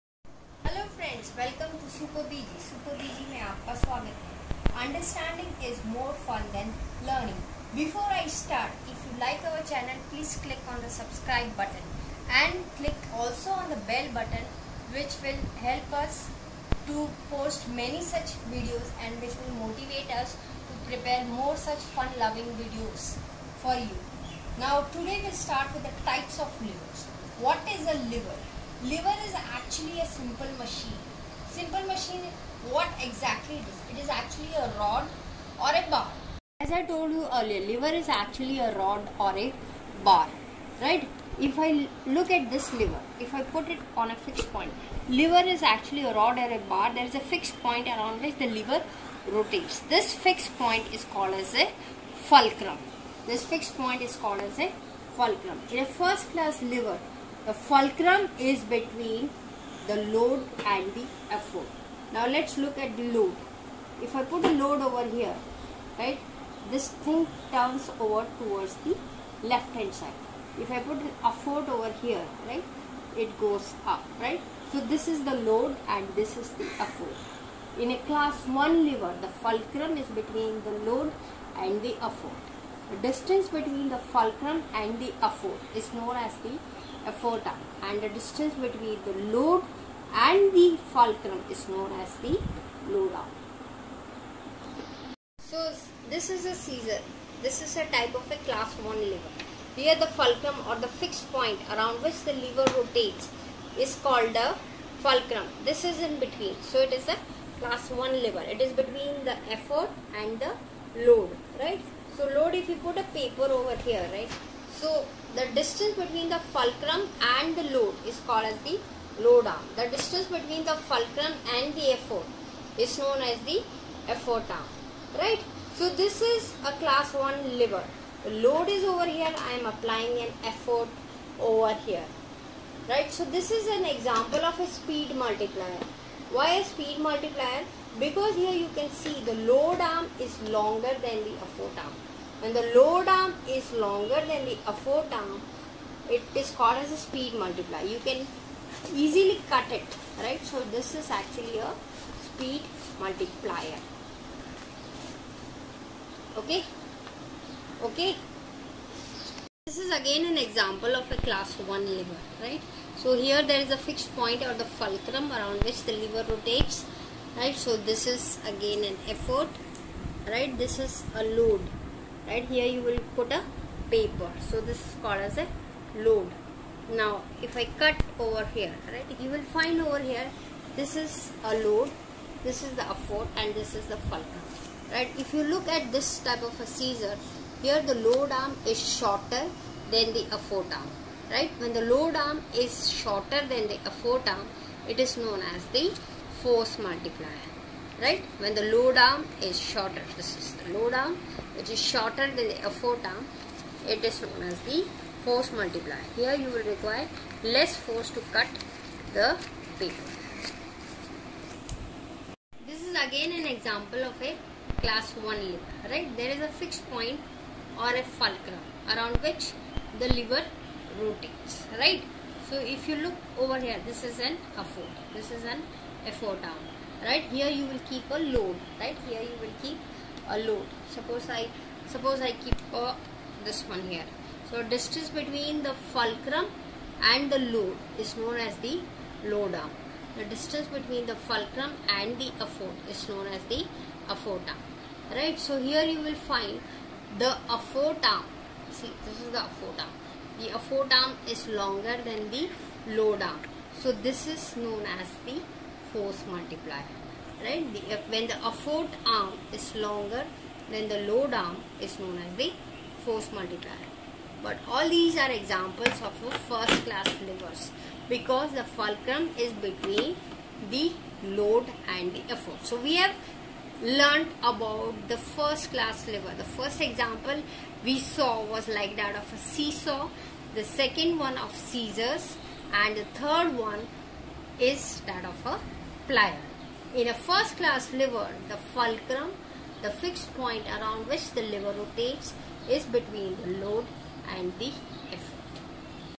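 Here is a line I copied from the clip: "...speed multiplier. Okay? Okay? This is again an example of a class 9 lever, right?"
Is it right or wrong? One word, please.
wrong.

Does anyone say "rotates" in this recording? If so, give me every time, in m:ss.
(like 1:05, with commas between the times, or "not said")
0:49, 1:42, 2:46, 3:40, 4:51.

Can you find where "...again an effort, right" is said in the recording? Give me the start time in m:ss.
2:48.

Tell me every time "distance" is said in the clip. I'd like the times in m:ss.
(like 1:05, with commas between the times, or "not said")
1:23, 1:28, 1:55, 1:59, 3:54, 4:00.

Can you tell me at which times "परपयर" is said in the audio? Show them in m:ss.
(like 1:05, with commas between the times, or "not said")
0:20.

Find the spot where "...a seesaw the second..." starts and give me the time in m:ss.
4:39.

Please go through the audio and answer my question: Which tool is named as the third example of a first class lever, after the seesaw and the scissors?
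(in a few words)
plier.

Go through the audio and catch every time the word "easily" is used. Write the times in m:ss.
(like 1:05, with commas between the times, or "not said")
2:28.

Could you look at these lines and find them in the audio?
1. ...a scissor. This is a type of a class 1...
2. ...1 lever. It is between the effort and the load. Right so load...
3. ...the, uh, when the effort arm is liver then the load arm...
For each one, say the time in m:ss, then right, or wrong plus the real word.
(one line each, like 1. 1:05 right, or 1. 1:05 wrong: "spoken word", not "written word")
1. 1:36 right
2. 1:47 right
3. 4:17 wrong: "longer", not "liver".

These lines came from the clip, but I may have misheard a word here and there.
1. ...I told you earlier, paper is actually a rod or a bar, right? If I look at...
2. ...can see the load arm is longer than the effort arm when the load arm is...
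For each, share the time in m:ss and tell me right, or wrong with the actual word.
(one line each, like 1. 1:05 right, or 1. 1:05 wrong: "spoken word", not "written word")
1. 0:36 wrong: "lever", not "paper"
2. 2:18 right.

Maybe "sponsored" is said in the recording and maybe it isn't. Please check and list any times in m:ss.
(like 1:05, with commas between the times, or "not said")
not said.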